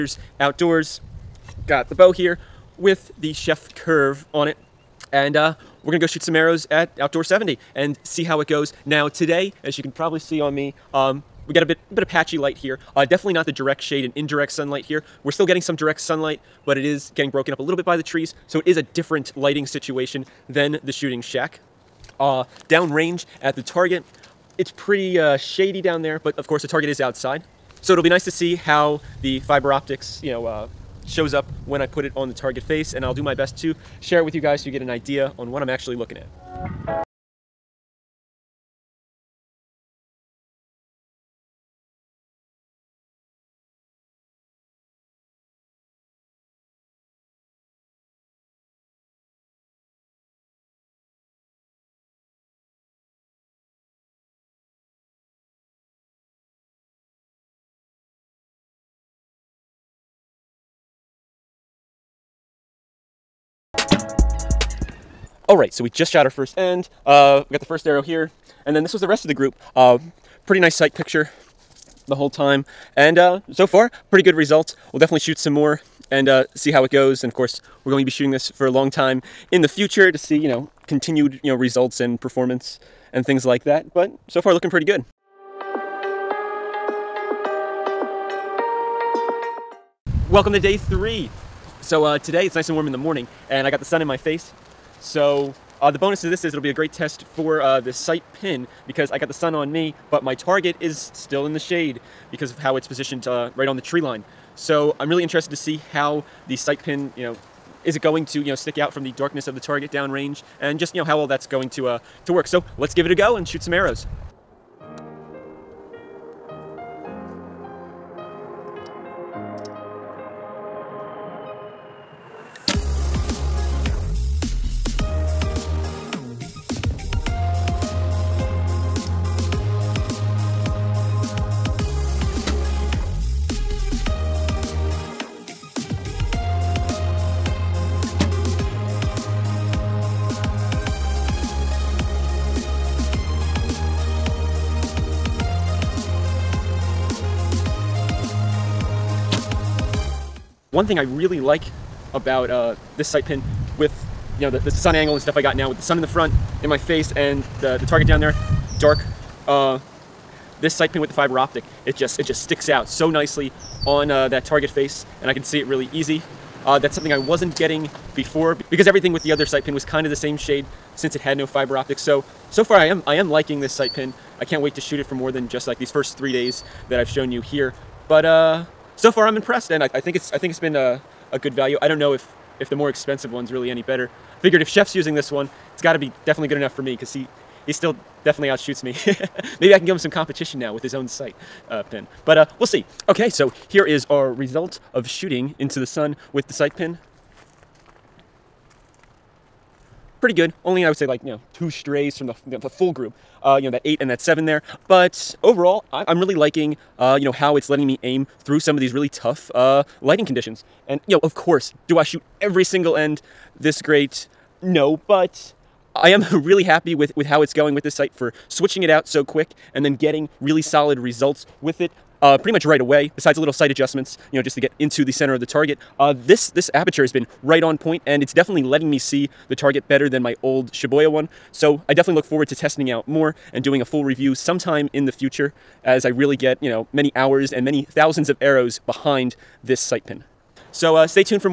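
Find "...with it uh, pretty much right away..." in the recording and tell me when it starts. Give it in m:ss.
3:41.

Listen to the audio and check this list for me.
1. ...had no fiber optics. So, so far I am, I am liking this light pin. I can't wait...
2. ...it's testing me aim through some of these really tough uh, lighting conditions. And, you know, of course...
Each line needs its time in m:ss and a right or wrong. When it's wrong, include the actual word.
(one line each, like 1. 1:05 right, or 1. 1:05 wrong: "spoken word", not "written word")
1. 2:51 wrong: "sight", not "light"
2. 3:27 wrong: "letting", not "testing".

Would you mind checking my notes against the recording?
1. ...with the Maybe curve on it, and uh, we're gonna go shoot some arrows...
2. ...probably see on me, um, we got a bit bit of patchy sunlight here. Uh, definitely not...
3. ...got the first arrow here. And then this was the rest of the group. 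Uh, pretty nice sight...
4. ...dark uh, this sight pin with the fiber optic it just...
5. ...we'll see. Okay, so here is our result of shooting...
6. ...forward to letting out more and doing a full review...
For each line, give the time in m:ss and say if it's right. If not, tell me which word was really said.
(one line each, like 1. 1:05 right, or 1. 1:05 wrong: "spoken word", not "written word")
1. 0:02 wrong: "Sjef", not "Maybe"
2. 0:09 wrong: "light", not "sunlight"
3. 1:07 right
4. 2:38 right
5. 3:12 right
6. 3:52 wrong: "testing", not "letting".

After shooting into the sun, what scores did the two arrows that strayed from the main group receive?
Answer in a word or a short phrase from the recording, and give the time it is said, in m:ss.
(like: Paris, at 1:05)
8 and 7, at 3:23.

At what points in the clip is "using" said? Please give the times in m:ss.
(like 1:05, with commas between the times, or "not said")
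3:04.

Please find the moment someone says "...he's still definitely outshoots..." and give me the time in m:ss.
3:07.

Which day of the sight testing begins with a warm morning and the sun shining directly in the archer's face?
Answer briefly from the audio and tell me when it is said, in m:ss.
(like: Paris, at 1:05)
Day 3, at 1:30.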